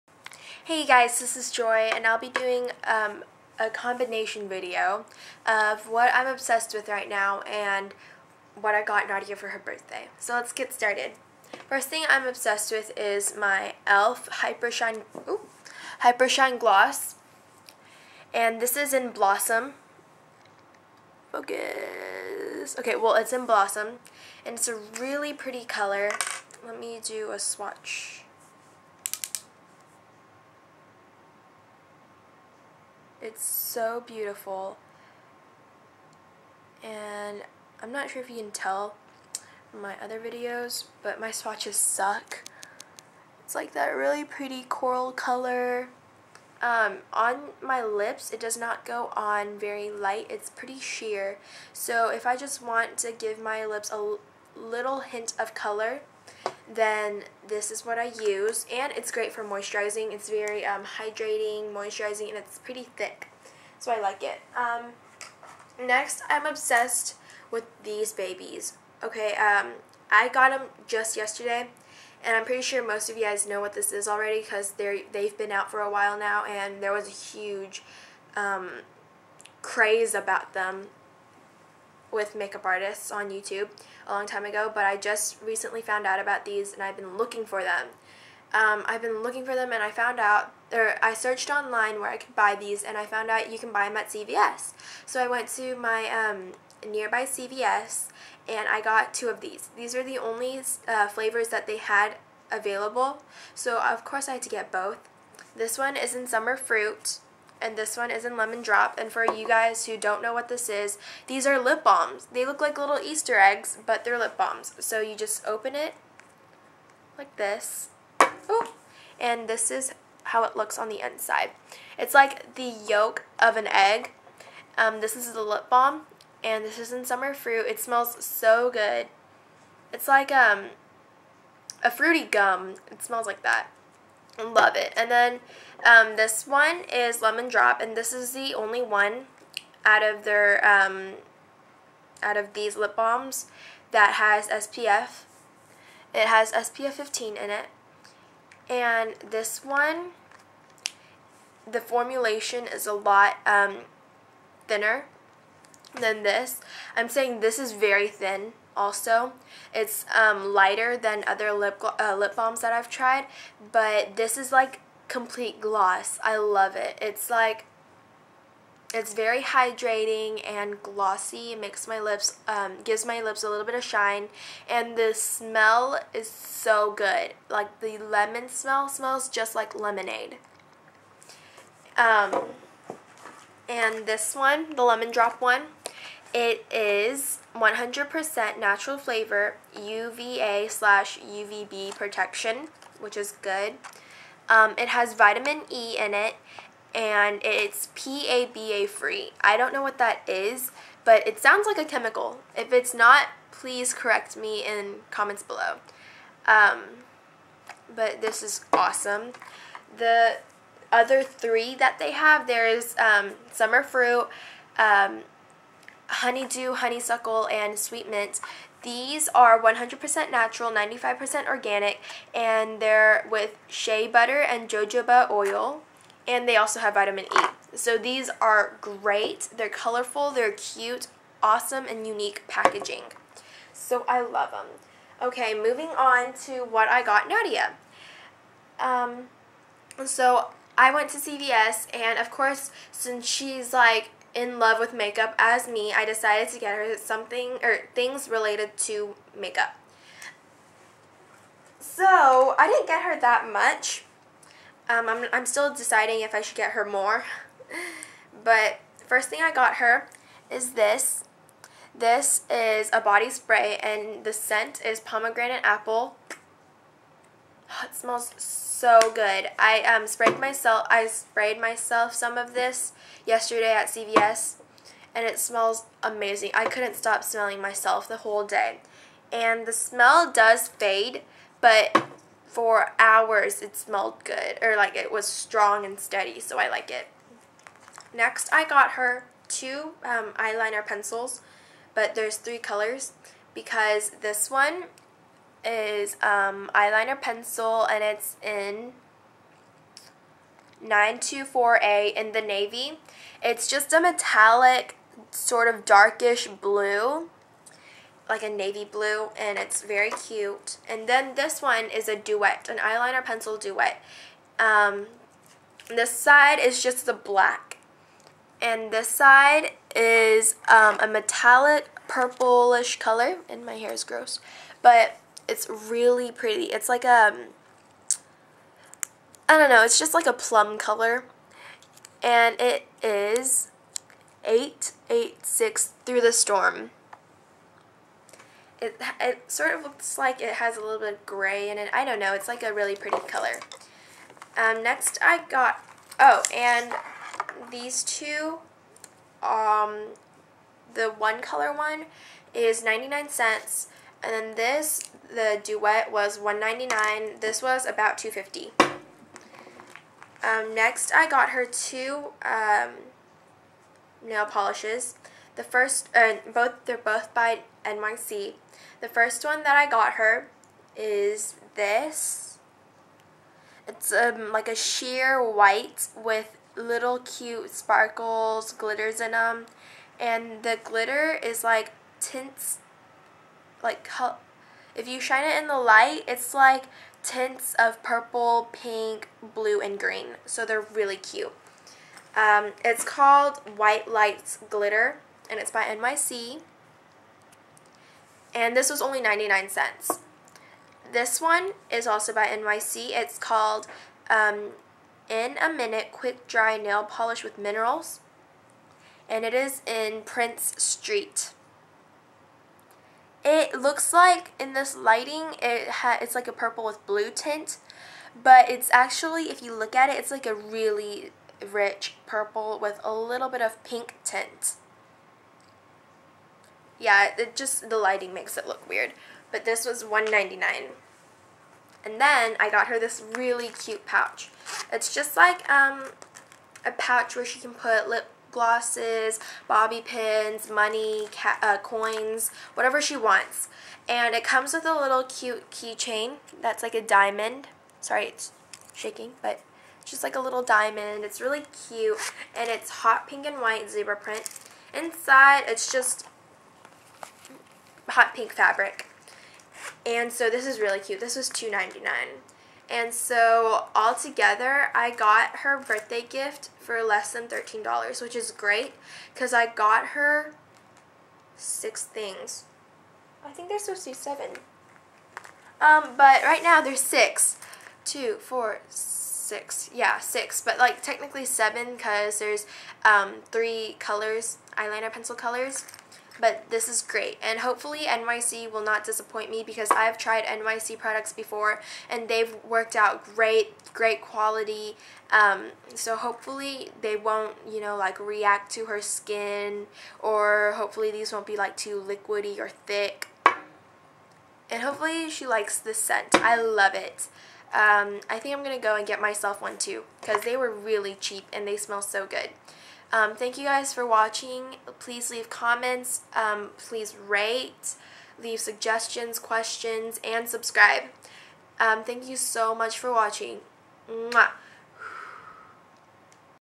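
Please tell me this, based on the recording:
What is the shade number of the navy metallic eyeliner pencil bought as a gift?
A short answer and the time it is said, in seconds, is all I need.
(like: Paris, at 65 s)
924A, at 298 s.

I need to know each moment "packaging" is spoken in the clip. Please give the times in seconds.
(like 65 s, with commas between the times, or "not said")
232 s.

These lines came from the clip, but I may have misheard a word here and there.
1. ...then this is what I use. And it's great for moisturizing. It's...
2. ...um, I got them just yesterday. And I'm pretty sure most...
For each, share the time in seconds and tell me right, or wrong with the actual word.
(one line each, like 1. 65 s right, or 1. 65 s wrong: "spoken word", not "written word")
1. 56 s right
2. 69 s right.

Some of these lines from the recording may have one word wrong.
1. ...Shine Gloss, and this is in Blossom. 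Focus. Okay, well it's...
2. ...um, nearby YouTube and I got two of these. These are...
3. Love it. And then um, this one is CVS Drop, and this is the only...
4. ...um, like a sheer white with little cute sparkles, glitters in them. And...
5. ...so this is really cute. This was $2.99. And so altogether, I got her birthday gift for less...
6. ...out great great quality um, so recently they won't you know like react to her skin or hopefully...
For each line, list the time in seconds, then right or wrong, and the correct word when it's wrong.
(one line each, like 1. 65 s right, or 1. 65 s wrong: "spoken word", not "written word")
1. 16 s right
2. 96 s wrong: "CVS", not "YouTube"
3. 134 s wrong: "Lemon", not "CVS"
4. 374 s right
5. 460 s right
6. 492 s wrong: "hopefully", not "recently".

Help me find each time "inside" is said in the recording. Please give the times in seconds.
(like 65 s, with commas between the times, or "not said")
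121 s, 454 s.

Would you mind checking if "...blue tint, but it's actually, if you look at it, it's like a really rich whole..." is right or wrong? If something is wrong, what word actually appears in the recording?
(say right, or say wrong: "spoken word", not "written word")
wrong: "purple", not "whole".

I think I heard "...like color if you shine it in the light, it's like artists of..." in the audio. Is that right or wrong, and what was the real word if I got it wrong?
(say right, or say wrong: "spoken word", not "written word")
wrong: "tints", not "artists".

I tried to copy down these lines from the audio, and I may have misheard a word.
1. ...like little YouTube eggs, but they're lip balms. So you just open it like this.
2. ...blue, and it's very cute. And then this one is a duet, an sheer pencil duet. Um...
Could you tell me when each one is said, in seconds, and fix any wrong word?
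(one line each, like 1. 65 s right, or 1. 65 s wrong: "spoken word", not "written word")
1. 112 s wrong: "Easter", not "YouTube"
2. 308 s wrong: "eyeliner", not "sheer".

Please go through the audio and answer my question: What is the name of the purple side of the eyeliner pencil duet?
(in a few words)
Through the Storm.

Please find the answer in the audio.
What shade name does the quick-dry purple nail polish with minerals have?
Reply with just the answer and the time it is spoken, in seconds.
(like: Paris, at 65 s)
Prince Street, at 409 s.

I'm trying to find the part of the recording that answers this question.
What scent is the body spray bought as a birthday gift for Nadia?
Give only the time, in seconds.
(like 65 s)
264 s.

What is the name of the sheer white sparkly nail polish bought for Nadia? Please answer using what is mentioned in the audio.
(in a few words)
White Lights Glitter.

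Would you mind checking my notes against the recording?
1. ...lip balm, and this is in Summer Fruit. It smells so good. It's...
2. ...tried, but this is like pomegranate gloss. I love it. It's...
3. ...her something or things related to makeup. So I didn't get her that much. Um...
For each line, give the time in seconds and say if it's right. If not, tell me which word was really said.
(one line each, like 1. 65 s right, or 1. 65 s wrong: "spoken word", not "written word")
1. 125 s right
2. 162 s wrong: "complete", not "pomegranate"
3. 246 s right.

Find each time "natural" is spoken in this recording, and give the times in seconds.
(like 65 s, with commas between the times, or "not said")
188 s, 220 s.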